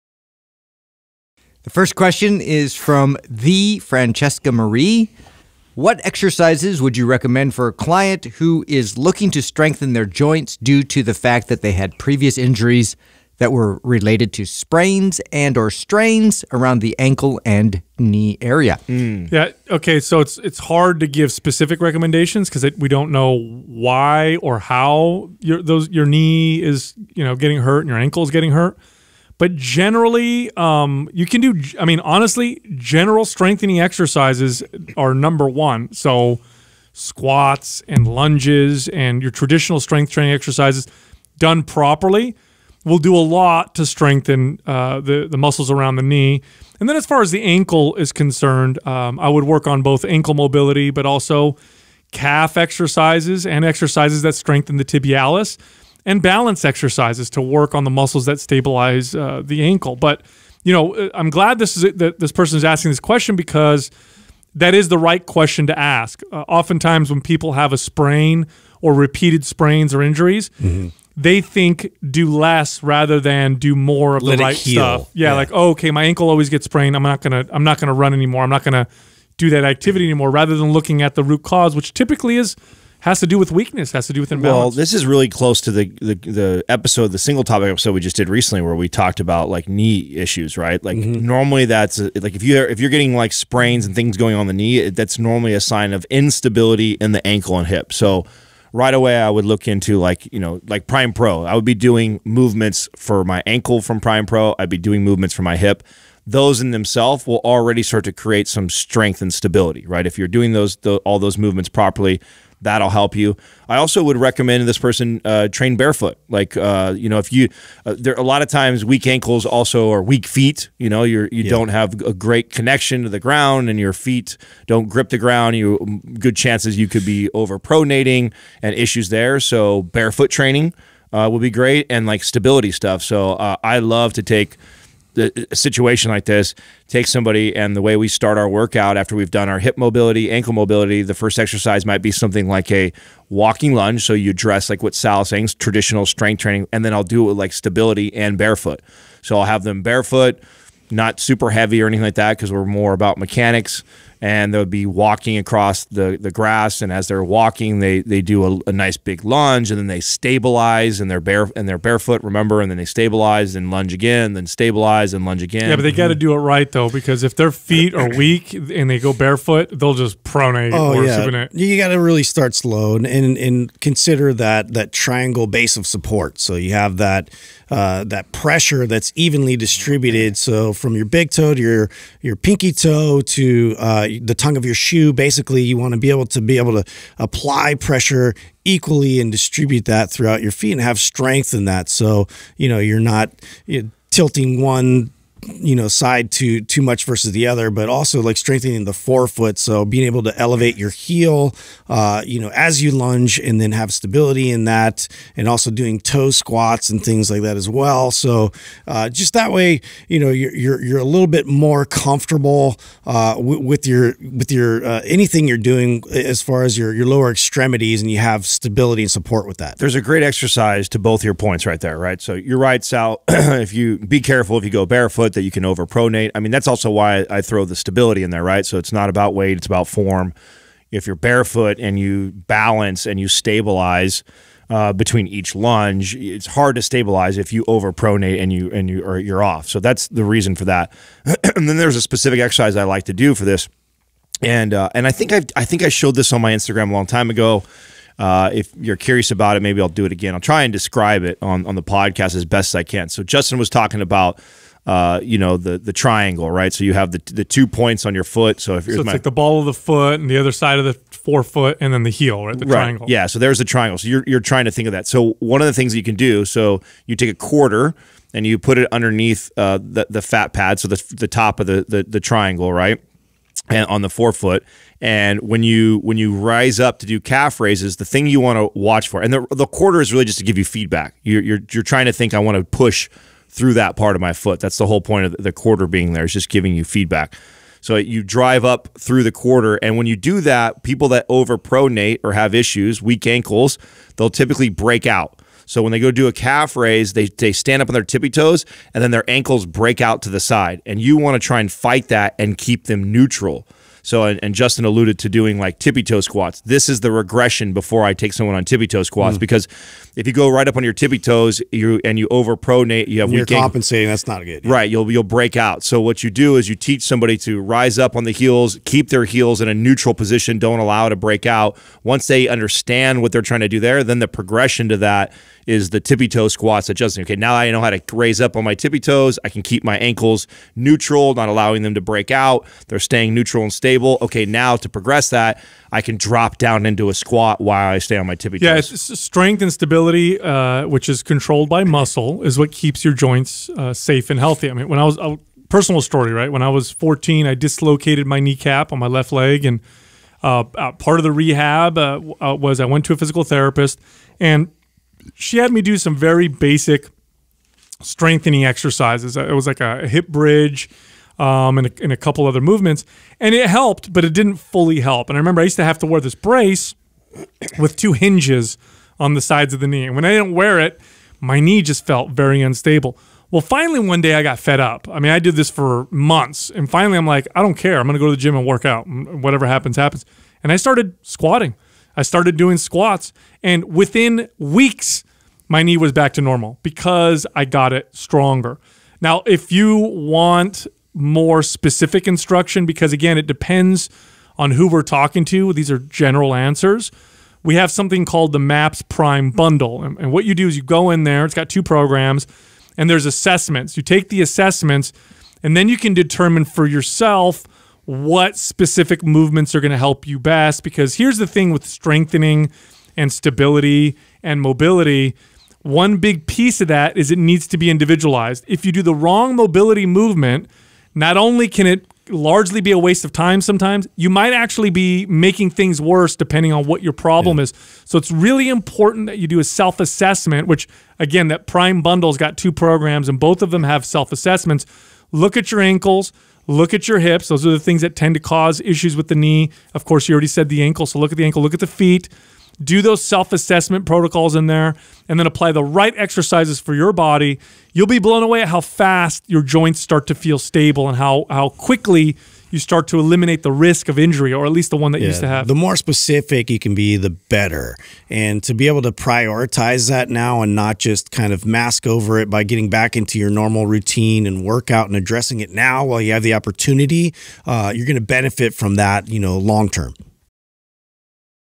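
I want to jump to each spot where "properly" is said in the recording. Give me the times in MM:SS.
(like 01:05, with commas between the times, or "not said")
00:41, 01:51.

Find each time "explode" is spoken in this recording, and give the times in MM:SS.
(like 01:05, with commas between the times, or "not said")
not said.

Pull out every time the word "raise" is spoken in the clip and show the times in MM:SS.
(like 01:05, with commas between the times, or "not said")
04:37, 04:56, 05:28.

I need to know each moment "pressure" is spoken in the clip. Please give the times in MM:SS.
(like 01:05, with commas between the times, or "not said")
02:58, 03:07.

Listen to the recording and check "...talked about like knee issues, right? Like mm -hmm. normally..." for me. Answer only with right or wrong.
right.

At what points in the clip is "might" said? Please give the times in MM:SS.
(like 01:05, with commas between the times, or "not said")
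02:21, 07:04.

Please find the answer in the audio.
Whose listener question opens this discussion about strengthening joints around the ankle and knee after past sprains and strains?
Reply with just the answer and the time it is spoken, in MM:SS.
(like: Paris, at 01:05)
Francesca Marie, at 00:03.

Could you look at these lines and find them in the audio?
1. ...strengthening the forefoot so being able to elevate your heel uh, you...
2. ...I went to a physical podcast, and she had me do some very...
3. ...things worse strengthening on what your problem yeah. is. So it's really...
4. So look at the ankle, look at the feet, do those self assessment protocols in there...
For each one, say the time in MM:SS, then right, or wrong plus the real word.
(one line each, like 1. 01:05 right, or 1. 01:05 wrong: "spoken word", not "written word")
1. 03:18 right
2. 05:52 wrong: "therapist", not "podcast"
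3. 07:05 wrong: "depending", not "strengthening"
4. 07:21 right.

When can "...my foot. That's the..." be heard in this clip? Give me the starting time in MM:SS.
04:44.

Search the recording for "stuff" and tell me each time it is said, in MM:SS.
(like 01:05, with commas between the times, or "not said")
01:14, 02:12.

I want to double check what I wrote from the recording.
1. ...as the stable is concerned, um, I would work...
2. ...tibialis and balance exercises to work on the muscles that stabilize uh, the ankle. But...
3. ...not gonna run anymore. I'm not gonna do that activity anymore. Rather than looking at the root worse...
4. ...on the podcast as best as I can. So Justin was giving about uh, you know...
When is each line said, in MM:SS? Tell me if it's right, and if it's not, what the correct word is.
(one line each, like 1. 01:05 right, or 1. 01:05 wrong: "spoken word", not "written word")
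1. 00:47 wrong: "ankle", not "stable"
2. 00:54 right
3. 01:17 wrong: "cause", not "worse"
4. 04:11 wrong: "talking", not "giving".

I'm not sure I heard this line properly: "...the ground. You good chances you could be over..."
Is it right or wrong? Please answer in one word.
right.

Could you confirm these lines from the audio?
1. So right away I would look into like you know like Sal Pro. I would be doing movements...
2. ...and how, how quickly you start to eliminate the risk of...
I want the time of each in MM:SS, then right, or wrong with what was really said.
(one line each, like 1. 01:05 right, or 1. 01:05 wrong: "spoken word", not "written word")
1. 01:37 wrong: "Prime", not "Sal"
2. 07:31 right.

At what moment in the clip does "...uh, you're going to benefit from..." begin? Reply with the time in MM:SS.
07:47.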